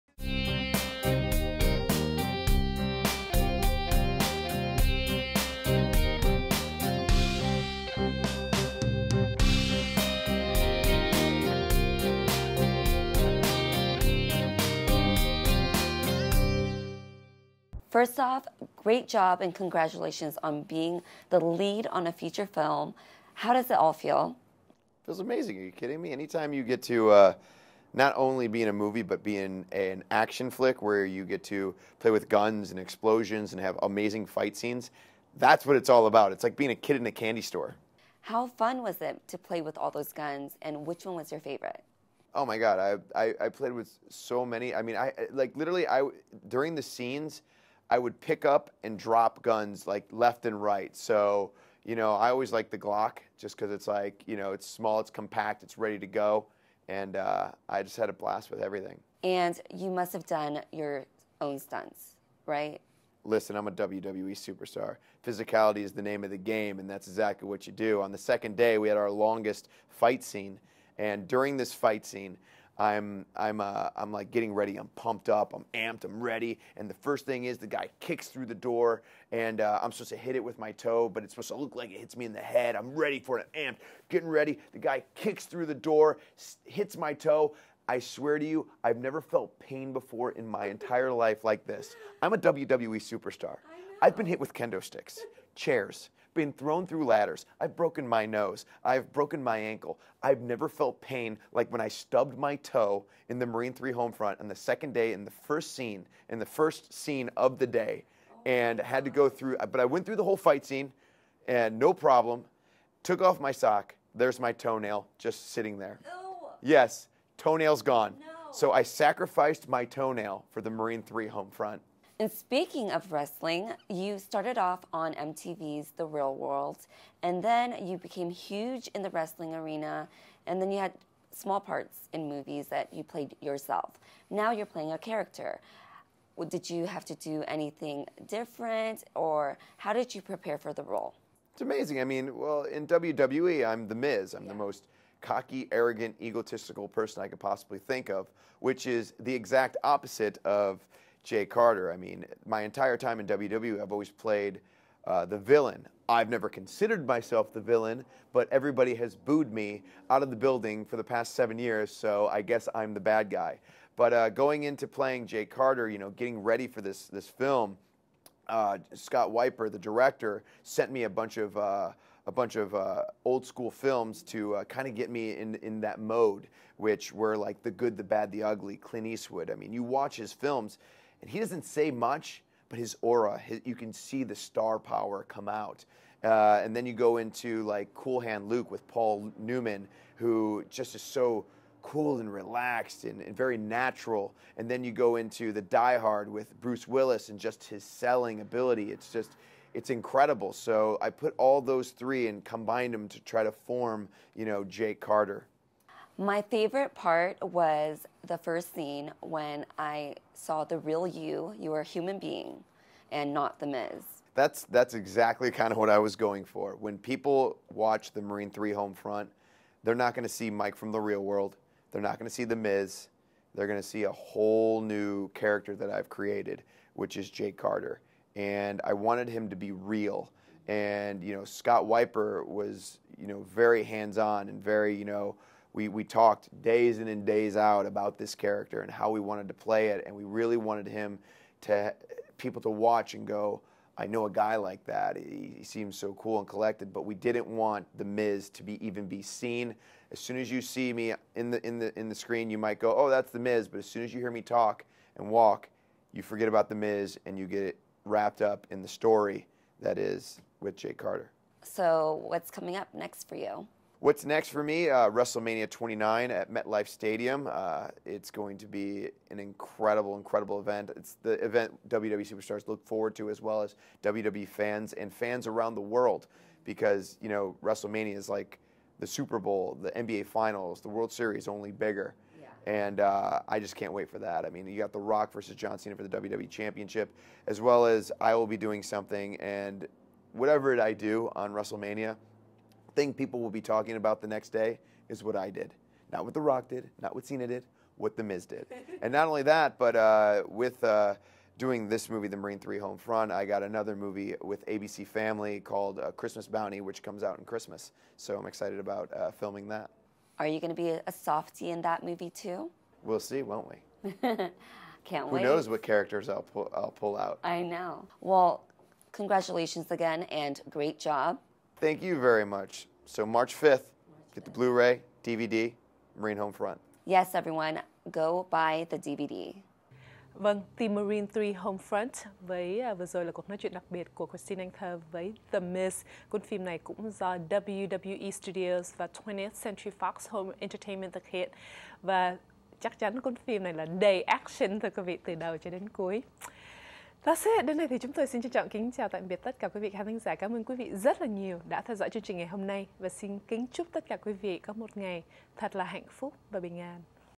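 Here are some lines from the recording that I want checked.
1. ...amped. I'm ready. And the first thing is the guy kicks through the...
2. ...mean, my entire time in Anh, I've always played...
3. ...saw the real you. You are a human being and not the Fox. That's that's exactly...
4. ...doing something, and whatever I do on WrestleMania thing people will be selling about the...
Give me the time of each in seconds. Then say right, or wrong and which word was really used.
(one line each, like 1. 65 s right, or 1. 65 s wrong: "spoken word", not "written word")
1. 75 s right
2. 151 s wrong: "WWE", not "Anh"
3. 210 s wrong: "Miz", not "Fox"
4. 288 s wrong: "talking", not "selling".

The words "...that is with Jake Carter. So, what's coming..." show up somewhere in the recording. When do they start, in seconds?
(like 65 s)
259 s.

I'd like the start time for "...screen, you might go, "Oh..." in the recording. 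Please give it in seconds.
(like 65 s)
252 s.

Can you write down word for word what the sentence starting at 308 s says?
So I'm excited about uh, filming that.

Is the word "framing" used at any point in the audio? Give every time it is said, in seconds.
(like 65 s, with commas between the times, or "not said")
not said.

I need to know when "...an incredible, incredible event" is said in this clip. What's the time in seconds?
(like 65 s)
269 s.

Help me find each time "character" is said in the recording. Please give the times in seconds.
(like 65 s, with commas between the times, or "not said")
134 s, 225 s, 238 s, 315 s.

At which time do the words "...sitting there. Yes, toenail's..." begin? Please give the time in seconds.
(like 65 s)
115 s.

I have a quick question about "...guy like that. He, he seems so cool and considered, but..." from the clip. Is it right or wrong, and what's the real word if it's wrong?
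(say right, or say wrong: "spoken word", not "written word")
wrong: "collected", not "considered".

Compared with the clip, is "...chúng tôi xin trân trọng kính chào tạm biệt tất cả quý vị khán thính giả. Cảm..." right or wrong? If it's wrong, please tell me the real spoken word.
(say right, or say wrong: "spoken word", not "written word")
right.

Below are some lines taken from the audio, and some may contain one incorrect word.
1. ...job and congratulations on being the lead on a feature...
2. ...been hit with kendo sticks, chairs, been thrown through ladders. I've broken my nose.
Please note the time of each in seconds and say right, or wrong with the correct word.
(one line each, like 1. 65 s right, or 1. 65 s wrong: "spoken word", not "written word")
1. 19 s right
2. 94 s right.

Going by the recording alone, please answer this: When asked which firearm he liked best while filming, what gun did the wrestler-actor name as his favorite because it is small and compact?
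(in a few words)
Glock.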